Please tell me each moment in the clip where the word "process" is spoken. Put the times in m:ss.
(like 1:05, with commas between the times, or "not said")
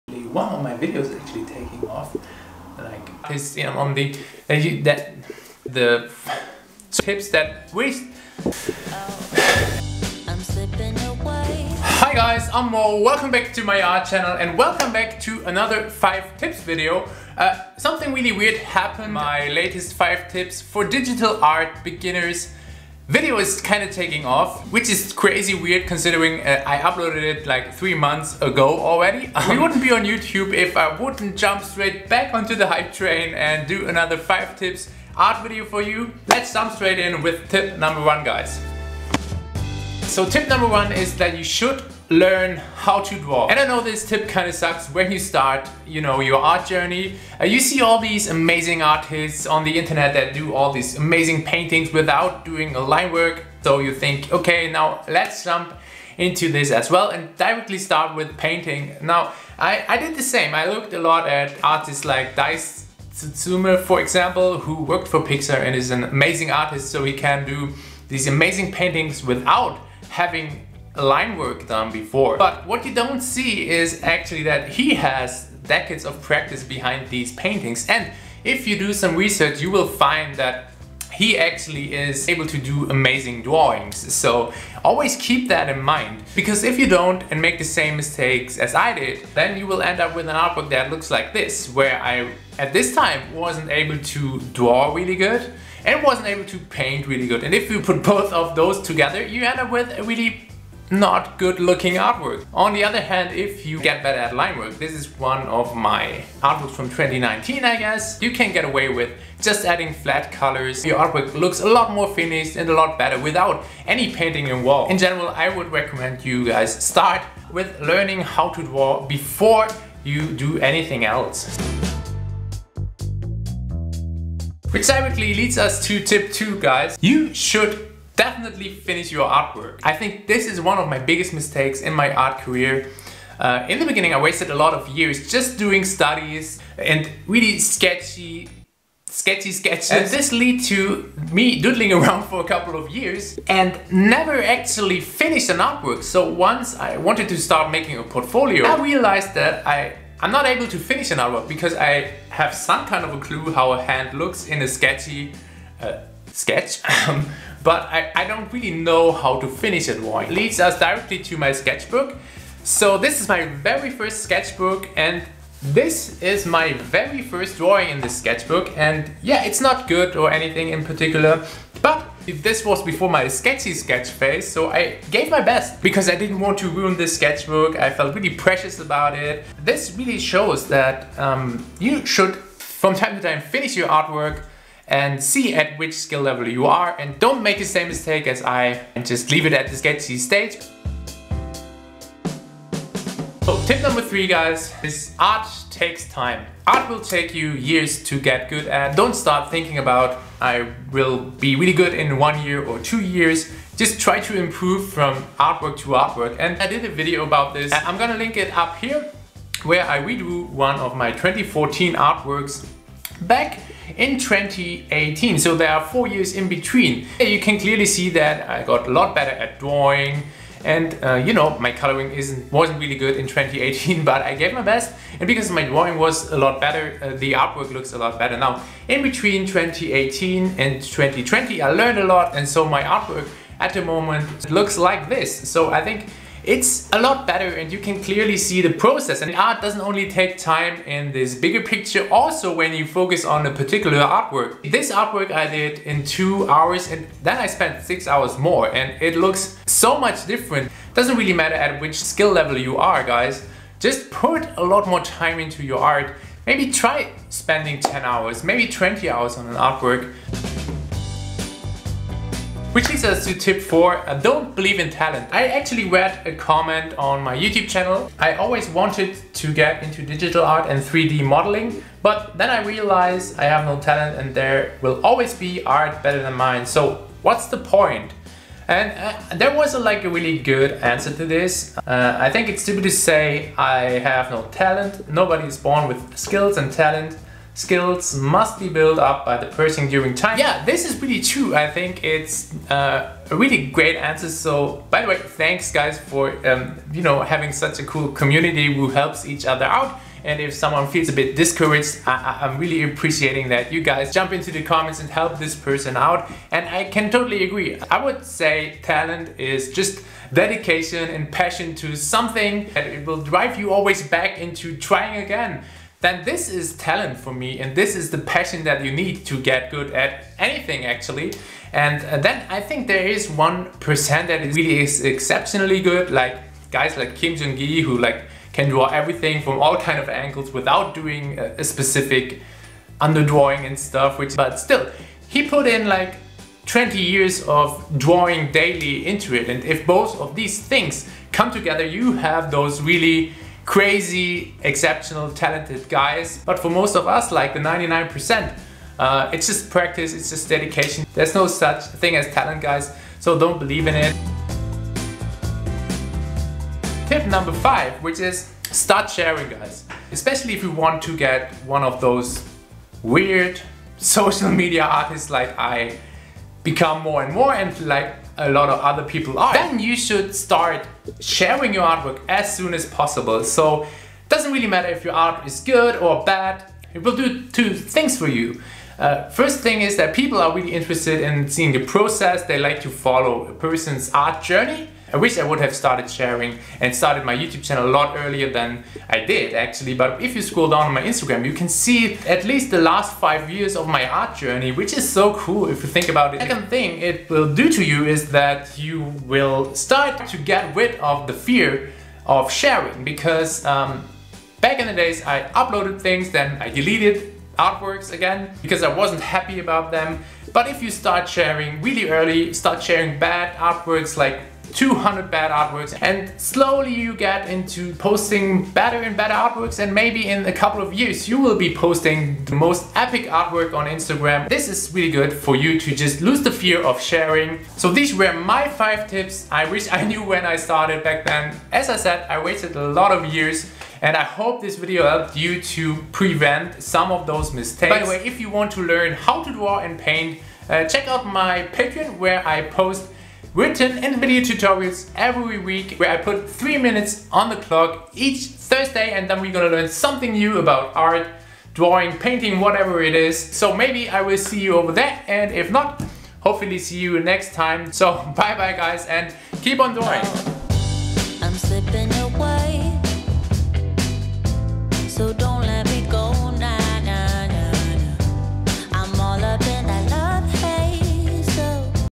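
3:58, 6:21.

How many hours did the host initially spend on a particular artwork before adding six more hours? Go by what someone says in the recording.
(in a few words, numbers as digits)
2.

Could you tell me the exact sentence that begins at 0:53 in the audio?
So you think, okay, now let's jump into this as well and directly start with painting.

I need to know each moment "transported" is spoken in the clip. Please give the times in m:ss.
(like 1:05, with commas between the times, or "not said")
not said.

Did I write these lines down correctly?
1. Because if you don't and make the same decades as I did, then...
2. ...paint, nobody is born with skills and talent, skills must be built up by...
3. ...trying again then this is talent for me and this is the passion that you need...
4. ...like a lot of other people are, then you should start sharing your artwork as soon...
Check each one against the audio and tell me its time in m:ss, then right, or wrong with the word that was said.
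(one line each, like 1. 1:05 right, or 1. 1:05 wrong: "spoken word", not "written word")
1. 1:26 wrong: "mistakes", not "decades"
2. 4:44 wrong: "talent", not "paint"
3. 5:14 right
4. 6:07 right.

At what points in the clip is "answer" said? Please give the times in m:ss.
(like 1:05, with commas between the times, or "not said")
4:40, 4:53.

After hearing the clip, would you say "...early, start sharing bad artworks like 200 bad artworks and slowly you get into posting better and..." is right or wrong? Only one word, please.
right.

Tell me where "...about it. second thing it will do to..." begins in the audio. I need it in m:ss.
6:36.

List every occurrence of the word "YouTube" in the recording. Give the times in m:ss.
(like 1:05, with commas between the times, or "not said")
0:30, 4:27, 6:27.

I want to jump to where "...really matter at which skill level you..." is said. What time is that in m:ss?
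4:11.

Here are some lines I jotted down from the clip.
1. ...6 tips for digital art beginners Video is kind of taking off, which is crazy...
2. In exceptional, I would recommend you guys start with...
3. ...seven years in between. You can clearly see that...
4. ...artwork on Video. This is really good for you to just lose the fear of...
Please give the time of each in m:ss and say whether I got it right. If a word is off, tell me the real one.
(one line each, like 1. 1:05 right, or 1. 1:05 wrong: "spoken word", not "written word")
1. 0:19 wrong: "5", not "6"
2. 1:54 wrong: "general", not "exceptional"
3. 3:35 wrong: "four", not "seven"
4. 7:03 wrong: "Instagram", not "Video".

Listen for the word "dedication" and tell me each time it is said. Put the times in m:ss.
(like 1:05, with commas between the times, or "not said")
5:10, 5:50.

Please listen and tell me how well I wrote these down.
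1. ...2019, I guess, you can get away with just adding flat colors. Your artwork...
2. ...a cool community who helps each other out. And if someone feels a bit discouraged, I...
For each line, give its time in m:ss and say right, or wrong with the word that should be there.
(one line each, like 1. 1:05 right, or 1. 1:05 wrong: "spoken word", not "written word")
1. 1:46 right
2. 4:57 right.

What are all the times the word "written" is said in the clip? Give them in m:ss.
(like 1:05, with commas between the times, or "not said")
7:23.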